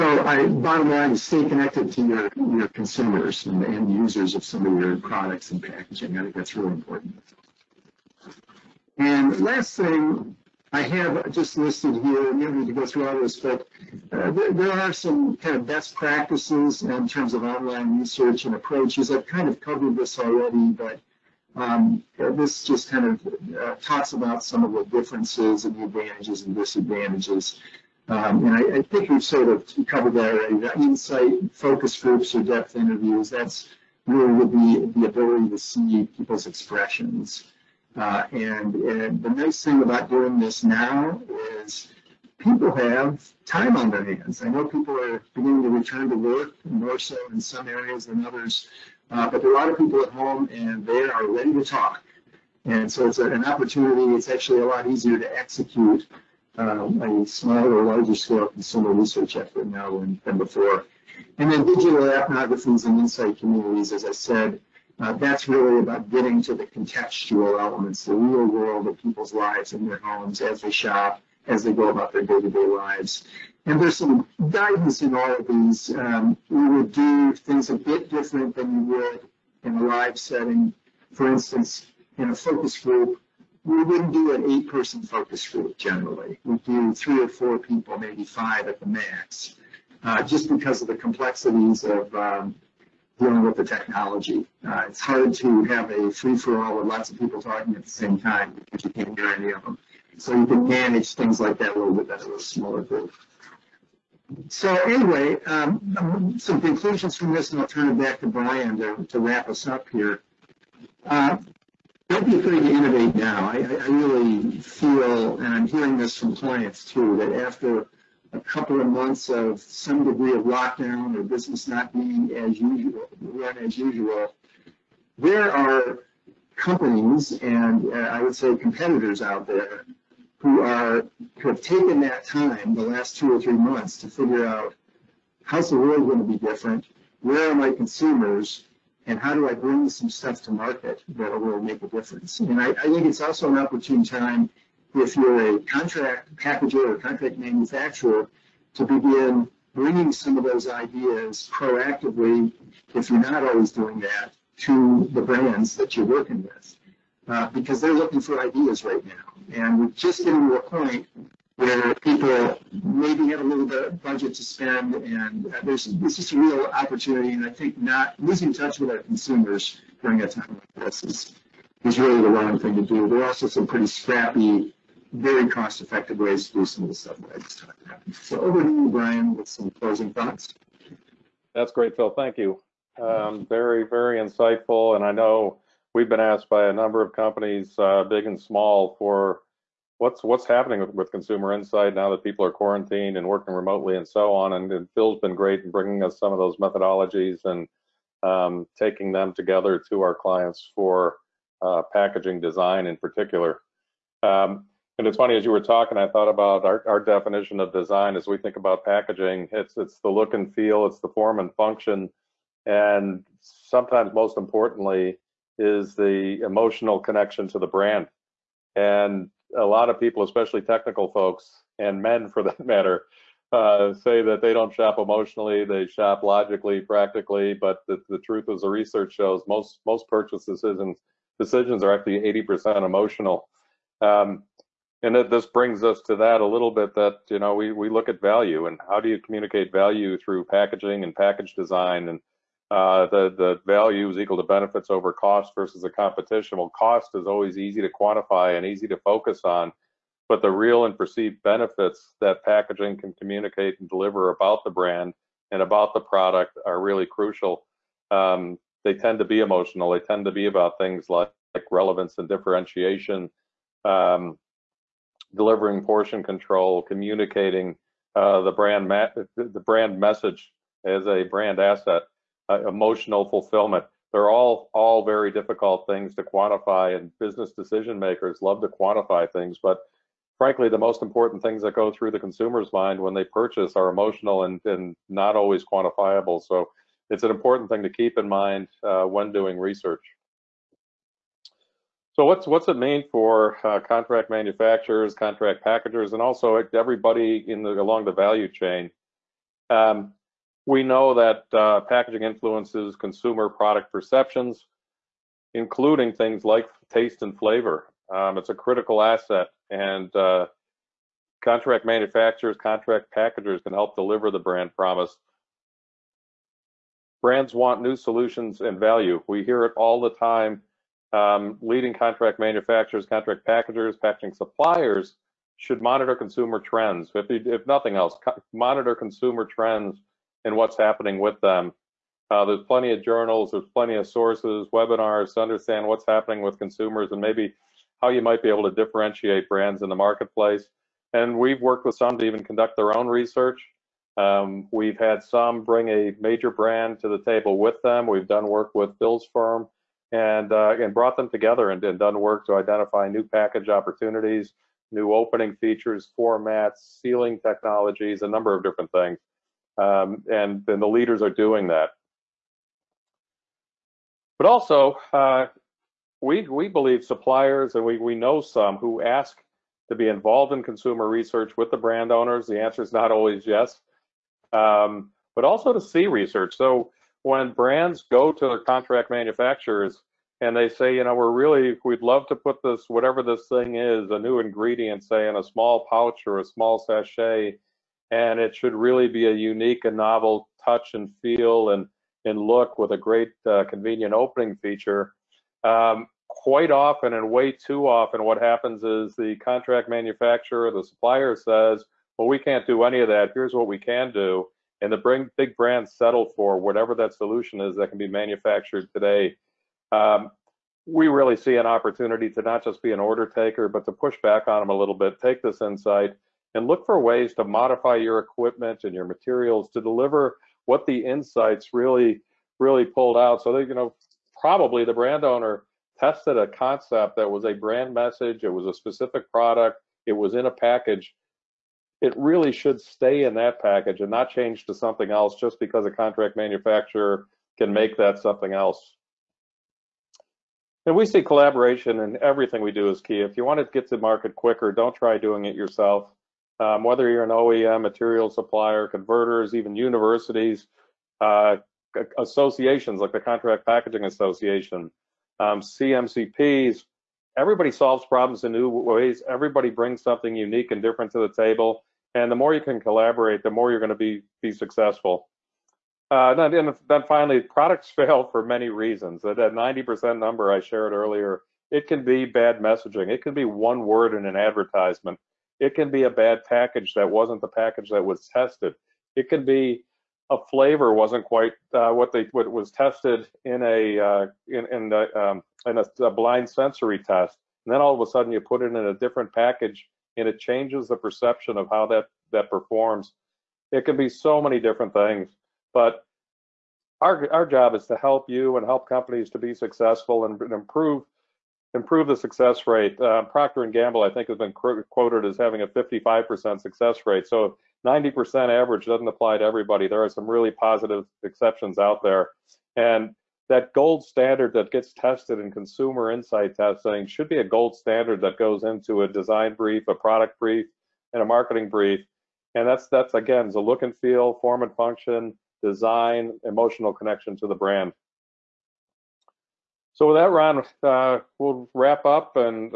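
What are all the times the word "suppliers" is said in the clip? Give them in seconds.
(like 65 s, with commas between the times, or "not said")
324 s, 367 s, 400 s, 448 s.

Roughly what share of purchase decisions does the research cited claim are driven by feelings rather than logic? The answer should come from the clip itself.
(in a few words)
80%.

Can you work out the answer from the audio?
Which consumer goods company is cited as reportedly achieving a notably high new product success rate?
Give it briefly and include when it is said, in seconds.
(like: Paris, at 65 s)
Procter and Gamble, at 503 s.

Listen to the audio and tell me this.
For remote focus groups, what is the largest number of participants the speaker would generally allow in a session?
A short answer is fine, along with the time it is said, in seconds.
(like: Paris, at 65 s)
5, at 88 s.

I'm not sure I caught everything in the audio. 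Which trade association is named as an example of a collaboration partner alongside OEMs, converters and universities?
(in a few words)
Contract Packaging Association.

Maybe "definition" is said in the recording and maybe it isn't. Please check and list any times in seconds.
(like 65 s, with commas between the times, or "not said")
206 s.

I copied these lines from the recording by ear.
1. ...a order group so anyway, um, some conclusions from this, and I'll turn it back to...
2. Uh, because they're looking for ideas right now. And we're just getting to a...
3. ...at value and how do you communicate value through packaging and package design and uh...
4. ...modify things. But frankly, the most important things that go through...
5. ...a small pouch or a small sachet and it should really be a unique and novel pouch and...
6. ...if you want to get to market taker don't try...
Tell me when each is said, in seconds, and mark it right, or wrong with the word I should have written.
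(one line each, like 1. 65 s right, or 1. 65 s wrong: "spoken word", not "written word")
1. 102 s wrong: "smaller", not "order"
2. 157 s right
3. 238 s right
4. 278 s wrong: "quantify", not "modify"
5. 385 s wrong: "touch", not "pouch"
6. 443 s wrong: "quicker", not "taker".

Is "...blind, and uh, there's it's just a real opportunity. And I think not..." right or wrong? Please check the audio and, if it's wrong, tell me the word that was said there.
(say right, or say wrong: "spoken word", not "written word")
wrong: "spend", not "blind".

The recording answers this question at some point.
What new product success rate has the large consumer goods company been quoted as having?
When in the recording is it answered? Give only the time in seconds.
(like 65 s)
505 s.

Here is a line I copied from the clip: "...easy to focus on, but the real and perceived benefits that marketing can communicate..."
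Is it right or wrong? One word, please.
wrong.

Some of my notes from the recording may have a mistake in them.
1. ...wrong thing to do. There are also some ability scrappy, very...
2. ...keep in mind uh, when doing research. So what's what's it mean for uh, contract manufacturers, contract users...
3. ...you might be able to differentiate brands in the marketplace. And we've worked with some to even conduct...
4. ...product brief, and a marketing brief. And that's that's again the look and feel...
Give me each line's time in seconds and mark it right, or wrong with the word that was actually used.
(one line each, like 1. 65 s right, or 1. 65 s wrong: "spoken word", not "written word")
1. 172 s wrong: "pretty", not "ability"
2. 287 s wrong: "packagers", not "users"
3. 338 s right
4. 519 s right.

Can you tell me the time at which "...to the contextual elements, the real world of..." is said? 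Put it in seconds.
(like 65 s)
66 s.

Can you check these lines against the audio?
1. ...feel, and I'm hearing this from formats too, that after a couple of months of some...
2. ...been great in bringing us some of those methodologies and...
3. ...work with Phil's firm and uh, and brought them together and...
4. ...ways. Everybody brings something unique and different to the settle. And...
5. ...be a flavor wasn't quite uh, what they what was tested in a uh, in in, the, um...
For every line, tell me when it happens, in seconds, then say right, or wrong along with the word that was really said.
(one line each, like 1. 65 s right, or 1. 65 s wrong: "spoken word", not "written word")
1. 114 s wrong: "clients", not "formats"
2. 195 s right
3. 348 s right
4. 458 s wrong: "table", not "settle"
5. 479 s right.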